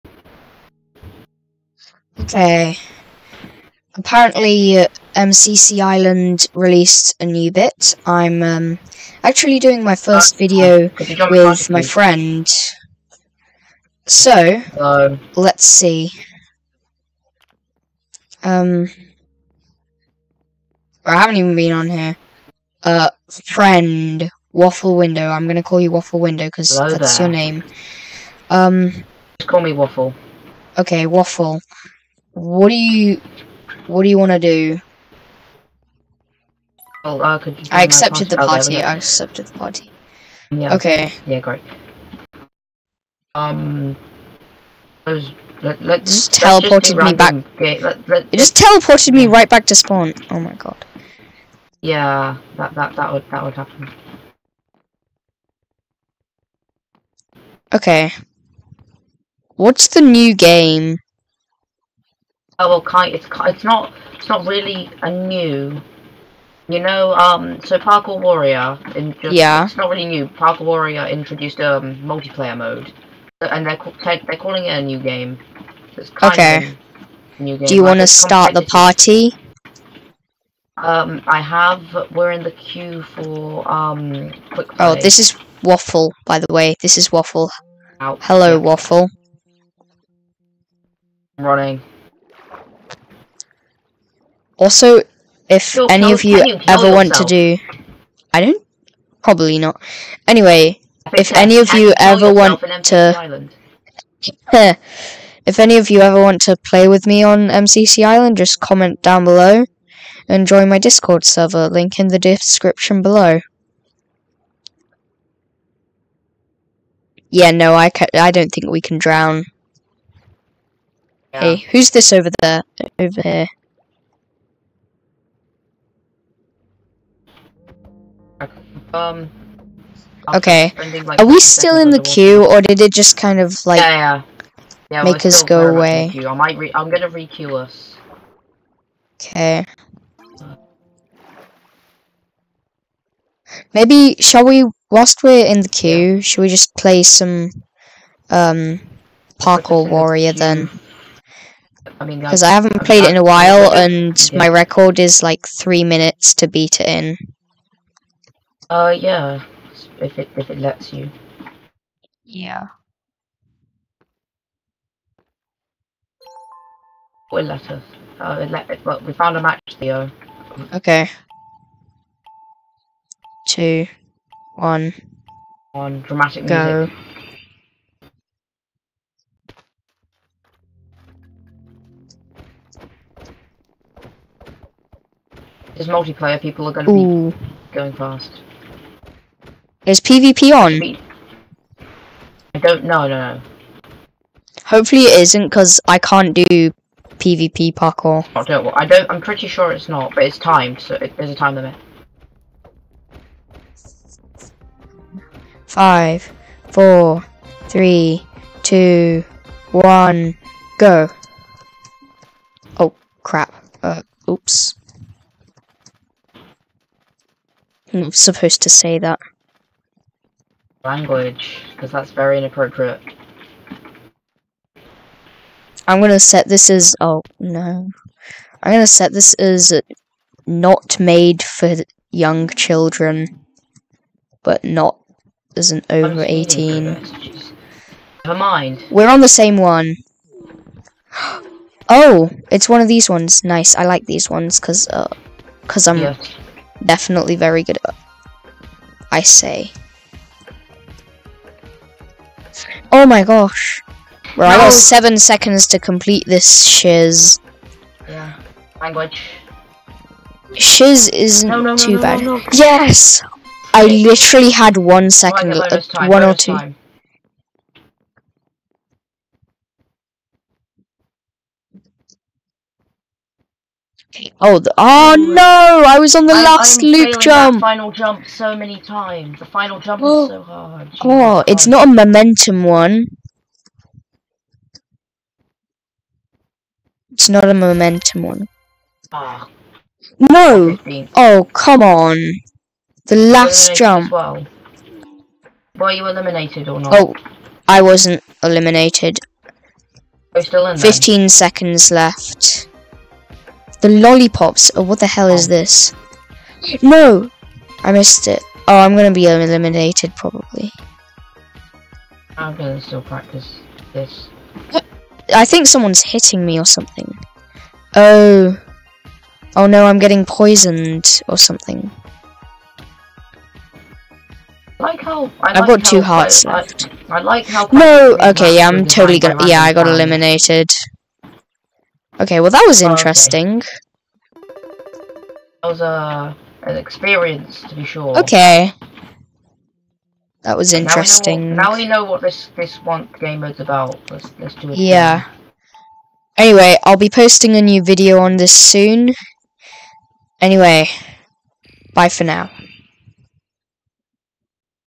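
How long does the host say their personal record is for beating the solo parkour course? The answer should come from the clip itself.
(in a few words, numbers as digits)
3 minutes.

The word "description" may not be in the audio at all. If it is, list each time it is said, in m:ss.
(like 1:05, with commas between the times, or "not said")
1:52.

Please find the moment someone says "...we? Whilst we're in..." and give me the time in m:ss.
2:24.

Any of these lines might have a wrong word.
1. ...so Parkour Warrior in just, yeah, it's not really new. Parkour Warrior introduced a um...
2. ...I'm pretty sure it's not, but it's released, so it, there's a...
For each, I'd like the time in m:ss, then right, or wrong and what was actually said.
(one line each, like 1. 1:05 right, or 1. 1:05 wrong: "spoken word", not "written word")
1. 1:07 right
2. 3:19 wrong: "timed", not "released".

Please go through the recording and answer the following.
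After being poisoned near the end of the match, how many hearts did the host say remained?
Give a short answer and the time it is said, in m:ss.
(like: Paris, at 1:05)
2, at 5:25.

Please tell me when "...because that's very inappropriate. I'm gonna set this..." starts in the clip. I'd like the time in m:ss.
3:41.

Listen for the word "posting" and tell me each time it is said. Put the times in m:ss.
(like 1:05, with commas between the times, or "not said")
5:47.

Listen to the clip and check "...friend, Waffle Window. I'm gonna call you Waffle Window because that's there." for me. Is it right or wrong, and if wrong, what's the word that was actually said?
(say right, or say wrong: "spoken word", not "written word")
right.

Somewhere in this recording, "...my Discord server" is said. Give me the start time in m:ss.
1:50.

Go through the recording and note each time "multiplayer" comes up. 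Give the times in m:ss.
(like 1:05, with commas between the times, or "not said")
1:11, 3:05.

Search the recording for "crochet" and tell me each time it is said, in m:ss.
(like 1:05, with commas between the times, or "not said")
not said.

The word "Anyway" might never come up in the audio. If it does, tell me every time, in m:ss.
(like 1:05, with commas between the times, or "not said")
1:40, 5:46, 5:50.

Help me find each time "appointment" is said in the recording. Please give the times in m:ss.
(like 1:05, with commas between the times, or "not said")
not said.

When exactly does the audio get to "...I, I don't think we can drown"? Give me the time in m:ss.
1:57.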